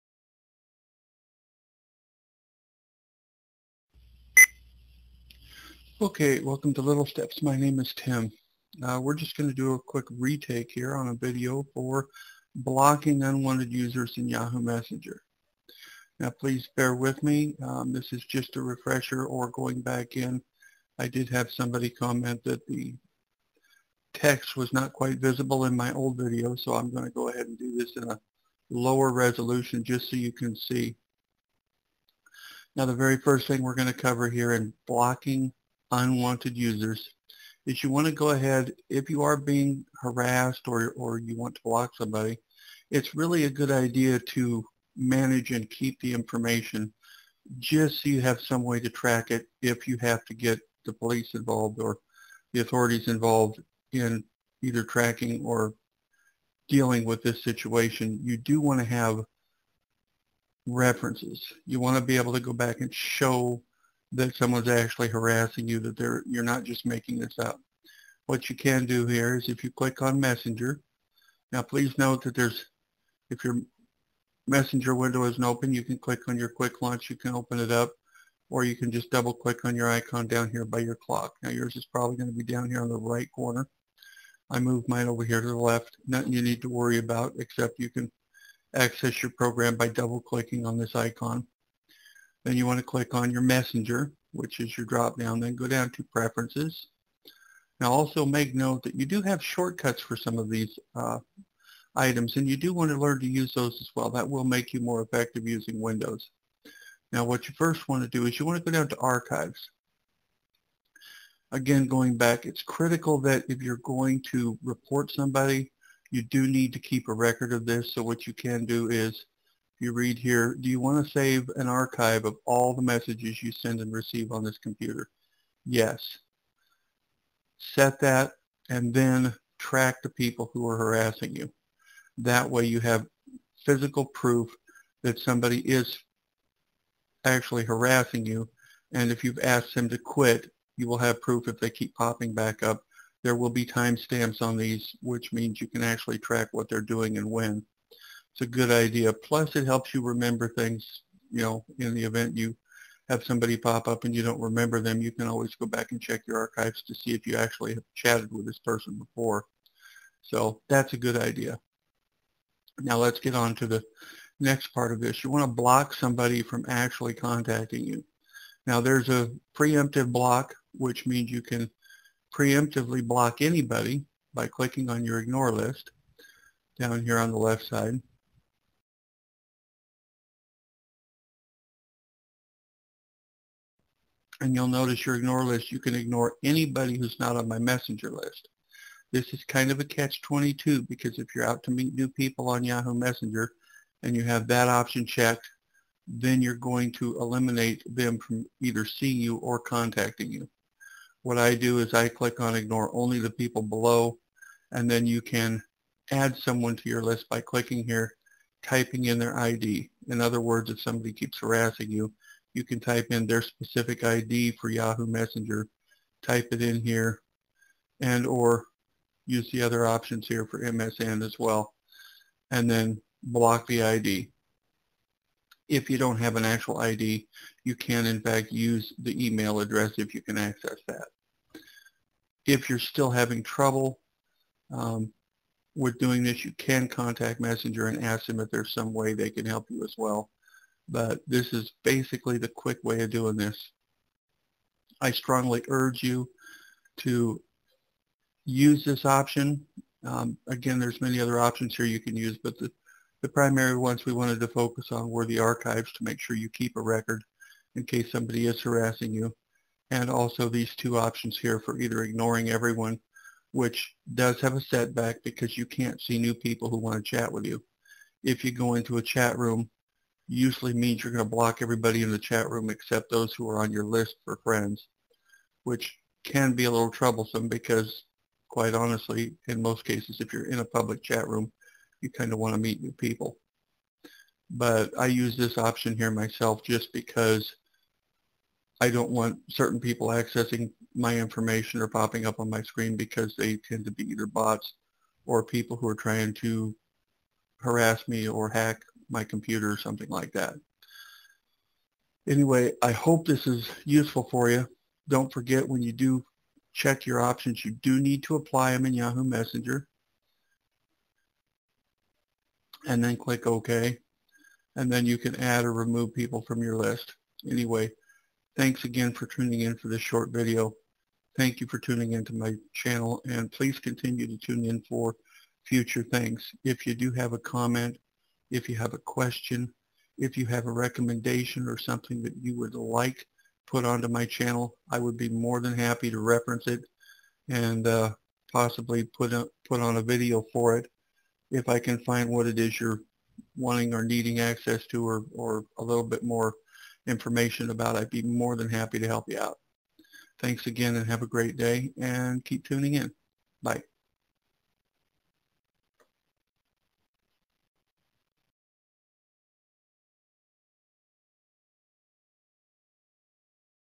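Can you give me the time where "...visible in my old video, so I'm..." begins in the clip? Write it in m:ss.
0:25.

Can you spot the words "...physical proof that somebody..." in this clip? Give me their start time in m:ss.
2:13.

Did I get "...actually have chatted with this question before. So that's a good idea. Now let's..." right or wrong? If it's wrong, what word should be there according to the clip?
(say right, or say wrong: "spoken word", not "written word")
wrong: "person", not "question".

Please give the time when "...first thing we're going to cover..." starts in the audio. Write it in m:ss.
0:33.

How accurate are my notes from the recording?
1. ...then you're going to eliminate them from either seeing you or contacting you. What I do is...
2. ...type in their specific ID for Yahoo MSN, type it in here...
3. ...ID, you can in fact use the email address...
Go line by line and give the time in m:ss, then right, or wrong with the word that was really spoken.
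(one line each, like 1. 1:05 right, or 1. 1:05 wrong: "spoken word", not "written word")
1. 3:16 right
2. 3:32 wrong: "Messenger", not "MSN"
3. 3:46 right.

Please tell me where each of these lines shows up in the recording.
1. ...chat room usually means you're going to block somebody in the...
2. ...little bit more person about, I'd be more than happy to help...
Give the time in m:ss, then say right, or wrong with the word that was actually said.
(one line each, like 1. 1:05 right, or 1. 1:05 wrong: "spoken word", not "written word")
1. 4:29 wrong: "everybody", not "somebody"
2. 5:45 wrong: "information", not "person".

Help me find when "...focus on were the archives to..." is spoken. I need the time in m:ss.
4:14.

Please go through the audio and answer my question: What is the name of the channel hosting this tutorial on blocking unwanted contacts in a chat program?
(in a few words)
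Little Steps.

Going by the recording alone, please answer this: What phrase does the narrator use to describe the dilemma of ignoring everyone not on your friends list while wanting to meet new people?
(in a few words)
Catch-22.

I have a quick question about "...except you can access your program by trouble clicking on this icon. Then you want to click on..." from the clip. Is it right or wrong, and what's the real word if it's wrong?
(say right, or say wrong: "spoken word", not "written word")
wrong: "double", not "trouble".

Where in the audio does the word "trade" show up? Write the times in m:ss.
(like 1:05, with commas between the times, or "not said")
not said.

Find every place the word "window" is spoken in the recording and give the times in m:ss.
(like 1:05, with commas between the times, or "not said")
1:14, 1:45.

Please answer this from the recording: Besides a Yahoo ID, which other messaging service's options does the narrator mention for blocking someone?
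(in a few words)
MSN.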